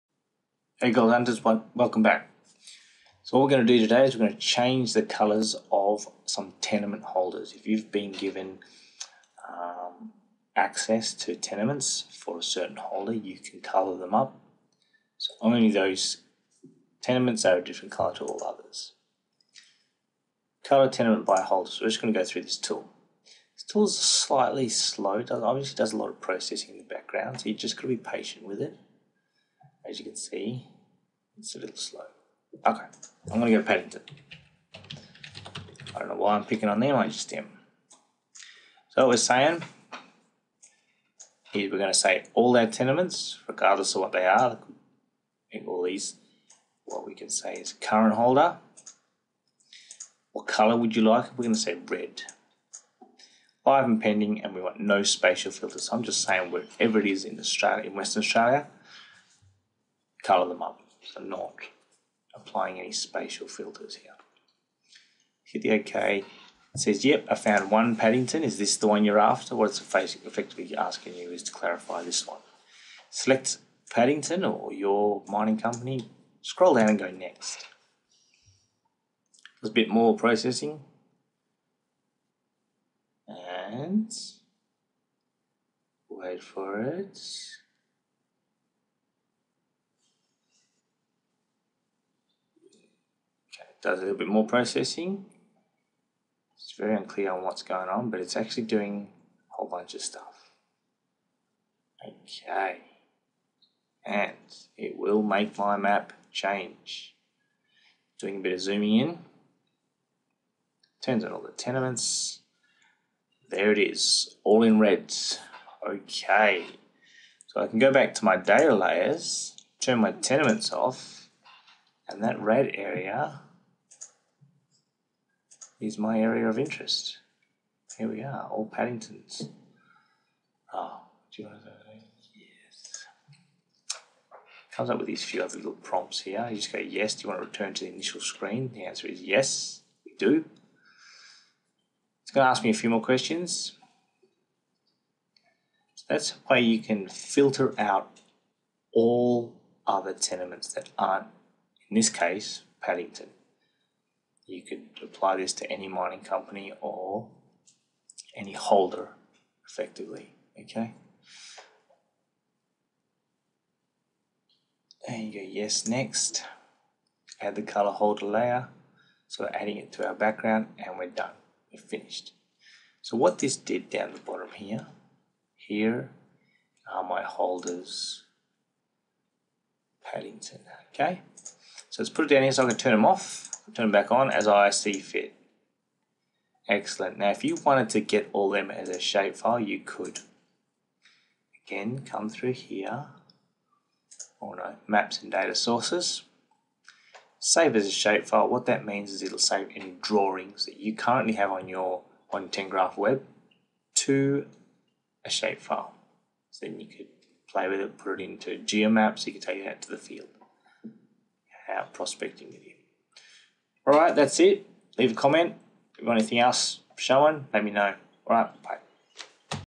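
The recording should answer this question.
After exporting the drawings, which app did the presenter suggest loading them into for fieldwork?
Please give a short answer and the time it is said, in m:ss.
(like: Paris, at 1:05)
Geomaps, at 3:28.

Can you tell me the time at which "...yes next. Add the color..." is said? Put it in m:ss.
2:45.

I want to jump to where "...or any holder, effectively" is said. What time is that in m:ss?
2:36.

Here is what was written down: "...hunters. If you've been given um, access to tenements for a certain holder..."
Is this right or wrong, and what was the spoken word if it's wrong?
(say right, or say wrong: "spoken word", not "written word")
wrong: "holders", not "hunters".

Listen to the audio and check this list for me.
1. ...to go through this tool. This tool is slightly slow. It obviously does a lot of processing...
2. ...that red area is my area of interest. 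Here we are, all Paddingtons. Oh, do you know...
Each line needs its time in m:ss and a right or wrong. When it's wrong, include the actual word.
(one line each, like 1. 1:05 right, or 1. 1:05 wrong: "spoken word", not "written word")
1. 0:22 right
2. 2:02 right.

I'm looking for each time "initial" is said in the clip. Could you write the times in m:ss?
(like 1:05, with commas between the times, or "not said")
2:17.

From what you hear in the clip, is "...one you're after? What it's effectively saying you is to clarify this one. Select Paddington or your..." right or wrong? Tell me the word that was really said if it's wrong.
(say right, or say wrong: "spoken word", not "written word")
wrong: "asking", not "saying".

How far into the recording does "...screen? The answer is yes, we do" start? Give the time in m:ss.
2:18.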